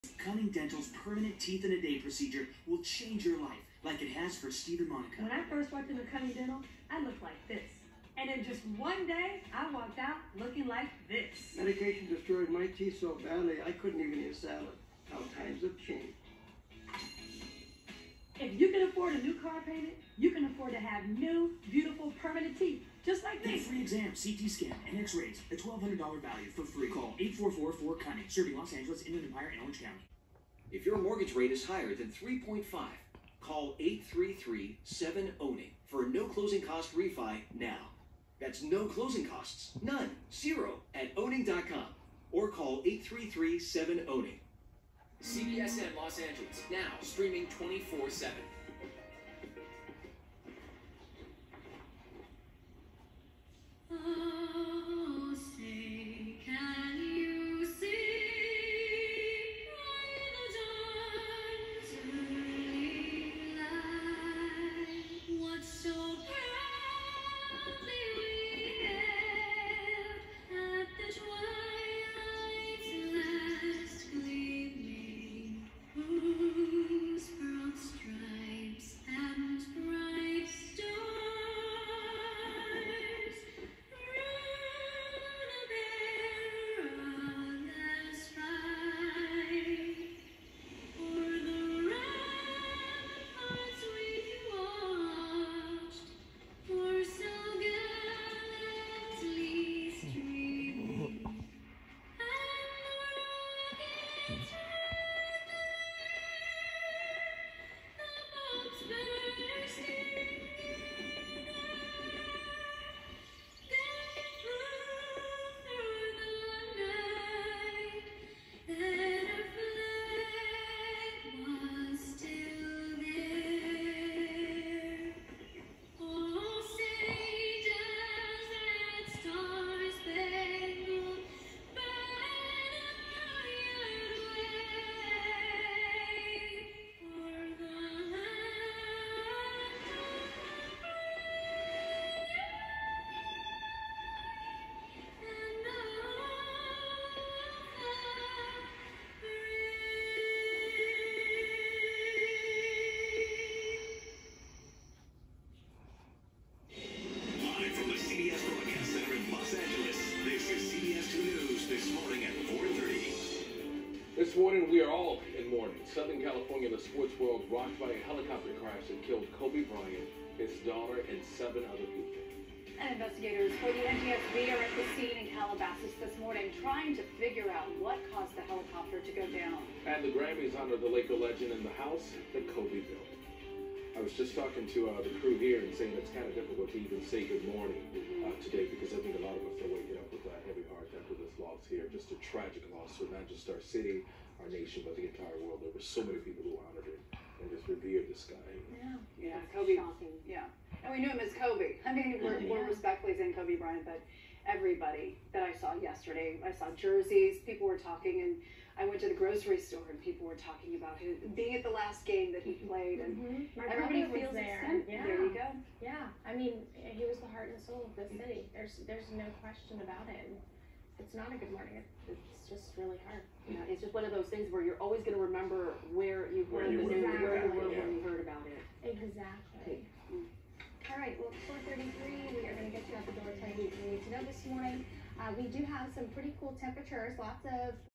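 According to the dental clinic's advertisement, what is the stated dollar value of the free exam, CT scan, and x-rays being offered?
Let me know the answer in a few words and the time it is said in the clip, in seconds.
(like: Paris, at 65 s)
$1,200, at 25 s.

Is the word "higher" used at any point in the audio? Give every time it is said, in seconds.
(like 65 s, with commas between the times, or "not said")
31 s.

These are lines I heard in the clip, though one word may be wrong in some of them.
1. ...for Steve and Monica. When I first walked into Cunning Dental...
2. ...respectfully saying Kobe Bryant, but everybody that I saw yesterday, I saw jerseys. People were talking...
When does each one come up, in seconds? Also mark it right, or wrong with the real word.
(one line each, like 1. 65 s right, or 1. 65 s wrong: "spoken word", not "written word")
1. 4 s right
2. 202 s right.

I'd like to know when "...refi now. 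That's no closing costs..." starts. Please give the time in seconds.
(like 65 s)
36 s.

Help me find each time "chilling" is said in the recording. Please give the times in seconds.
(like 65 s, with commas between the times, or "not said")
not said.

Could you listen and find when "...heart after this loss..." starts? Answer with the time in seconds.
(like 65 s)
190 s.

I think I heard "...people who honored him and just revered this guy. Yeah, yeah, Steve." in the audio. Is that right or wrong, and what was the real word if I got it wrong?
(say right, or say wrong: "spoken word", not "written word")
wrong: "Kobe", not "Steve".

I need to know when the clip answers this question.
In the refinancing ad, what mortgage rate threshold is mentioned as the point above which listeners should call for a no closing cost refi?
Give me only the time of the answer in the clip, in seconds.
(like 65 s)
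32 s.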